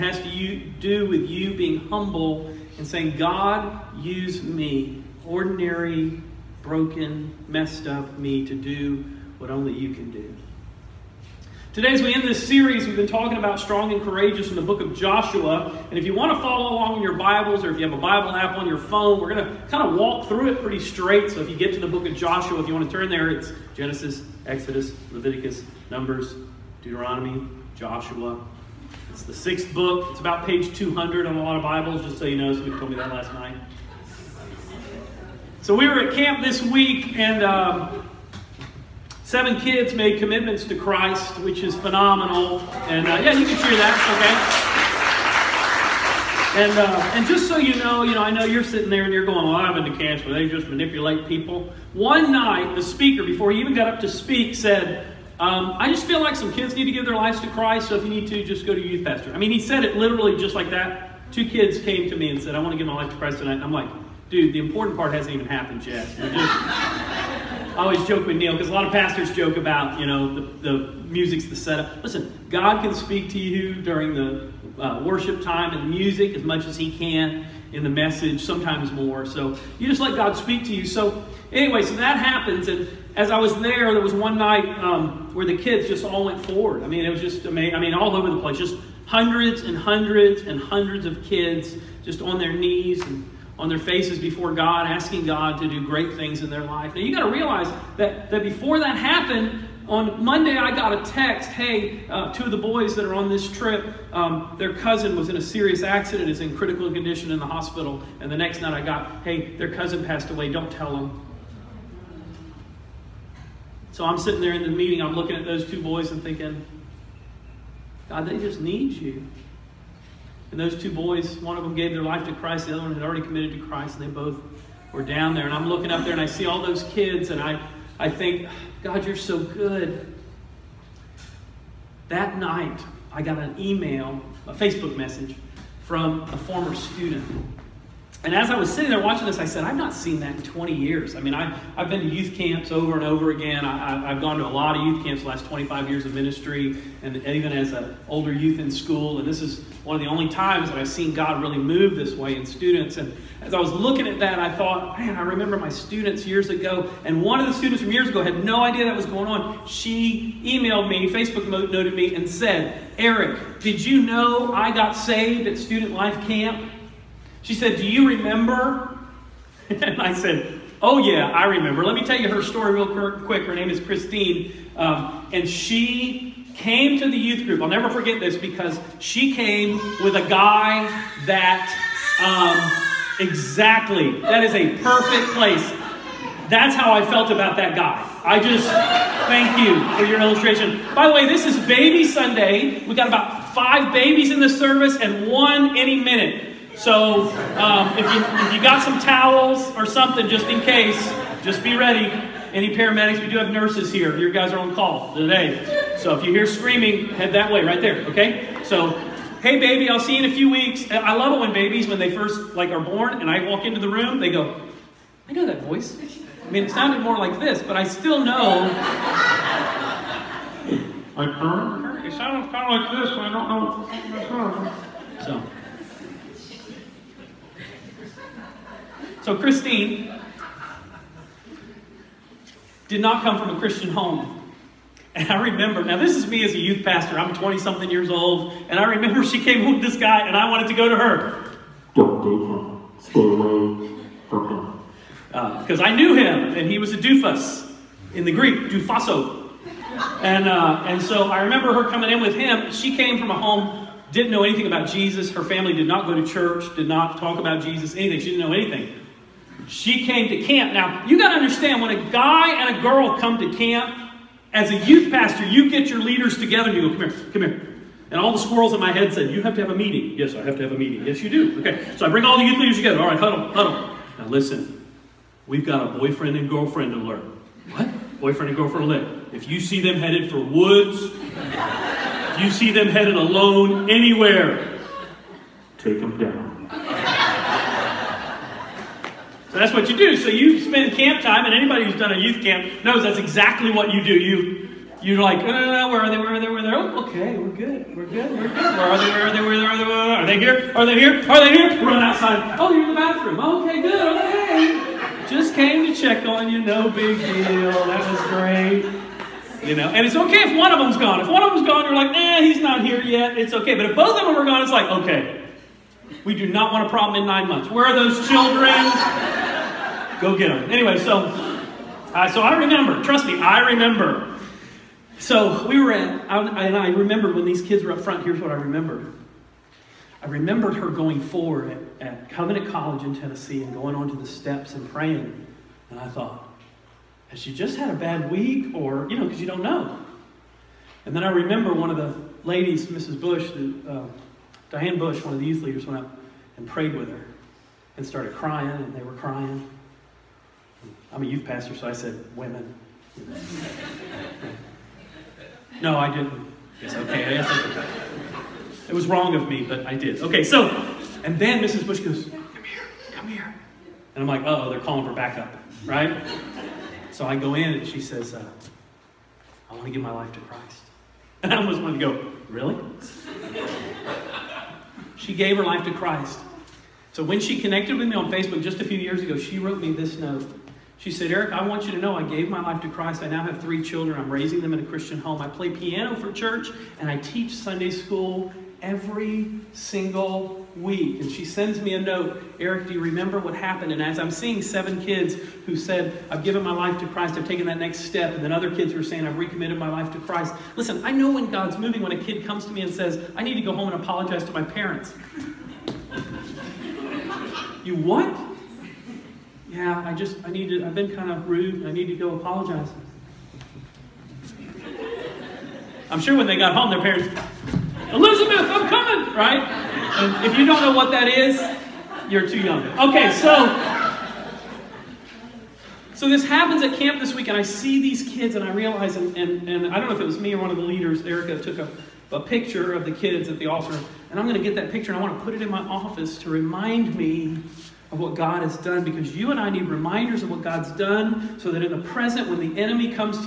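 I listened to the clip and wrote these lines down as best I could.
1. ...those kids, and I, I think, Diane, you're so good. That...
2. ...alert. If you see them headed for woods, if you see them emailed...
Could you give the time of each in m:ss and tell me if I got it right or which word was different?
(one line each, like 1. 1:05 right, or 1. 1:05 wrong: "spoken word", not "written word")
1. 2:06 wrong: "God", not "Diane"
2. 4:38 wrong: "headed", not "emailed".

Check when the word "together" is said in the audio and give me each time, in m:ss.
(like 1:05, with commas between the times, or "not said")
4:26, 4:32.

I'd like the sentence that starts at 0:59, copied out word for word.
I mean, he said it literally just like that.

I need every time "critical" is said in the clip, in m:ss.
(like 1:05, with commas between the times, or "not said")
1:46.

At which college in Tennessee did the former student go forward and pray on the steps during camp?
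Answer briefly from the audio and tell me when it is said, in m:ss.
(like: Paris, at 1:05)
Covenant College, at 5:32.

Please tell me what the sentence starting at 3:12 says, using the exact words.
We got about five babies in the service and one any minute.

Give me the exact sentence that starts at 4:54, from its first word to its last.
You, you're like, oh, no, no, no, where are they?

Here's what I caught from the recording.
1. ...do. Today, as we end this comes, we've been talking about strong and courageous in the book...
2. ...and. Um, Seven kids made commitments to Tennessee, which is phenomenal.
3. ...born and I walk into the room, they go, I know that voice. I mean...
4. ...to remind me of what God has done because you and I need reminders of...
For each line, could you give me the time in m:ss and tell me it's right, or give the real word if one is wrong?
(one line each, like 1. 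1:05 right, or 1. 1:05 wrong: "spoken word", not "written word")
1. 0:10 wrong: "series", not "comes"
2. 0:37 wrong: "Christ", not "Tennessee"
3. 3:32 right
4. 7:16 right.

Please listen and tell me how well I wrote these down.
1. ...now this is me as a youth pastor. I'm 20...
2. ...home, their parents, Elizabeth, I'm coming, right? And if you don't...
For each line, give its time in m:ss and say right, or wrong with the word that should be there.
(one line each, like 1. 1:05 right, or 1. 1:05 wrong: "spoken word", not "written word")
1. 3:55 right
2. 6:56 right.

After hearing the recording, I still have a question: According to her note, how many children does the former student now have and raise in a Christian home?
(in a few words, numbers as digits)
3.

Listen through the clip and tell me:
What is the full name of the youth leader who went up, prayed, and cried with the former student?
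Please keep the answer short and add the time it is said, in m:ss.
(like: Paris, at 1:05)
Diane Bush, at 5:44.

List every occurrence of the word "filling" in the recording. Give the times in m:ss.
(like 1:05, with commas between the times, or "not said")
not said.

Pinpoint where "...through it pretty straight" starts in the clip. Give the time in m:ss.
0:20.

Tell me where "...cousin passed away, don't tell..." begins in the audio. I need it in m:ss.
1:49.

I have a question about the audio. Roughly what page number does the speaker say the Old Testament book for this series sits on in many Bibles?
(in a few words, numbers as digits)
200.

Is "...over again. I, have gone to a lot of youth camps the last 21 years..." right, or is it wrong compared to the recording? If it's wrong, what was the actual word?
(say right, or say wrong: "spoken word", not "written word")
wrong: "25", not "21".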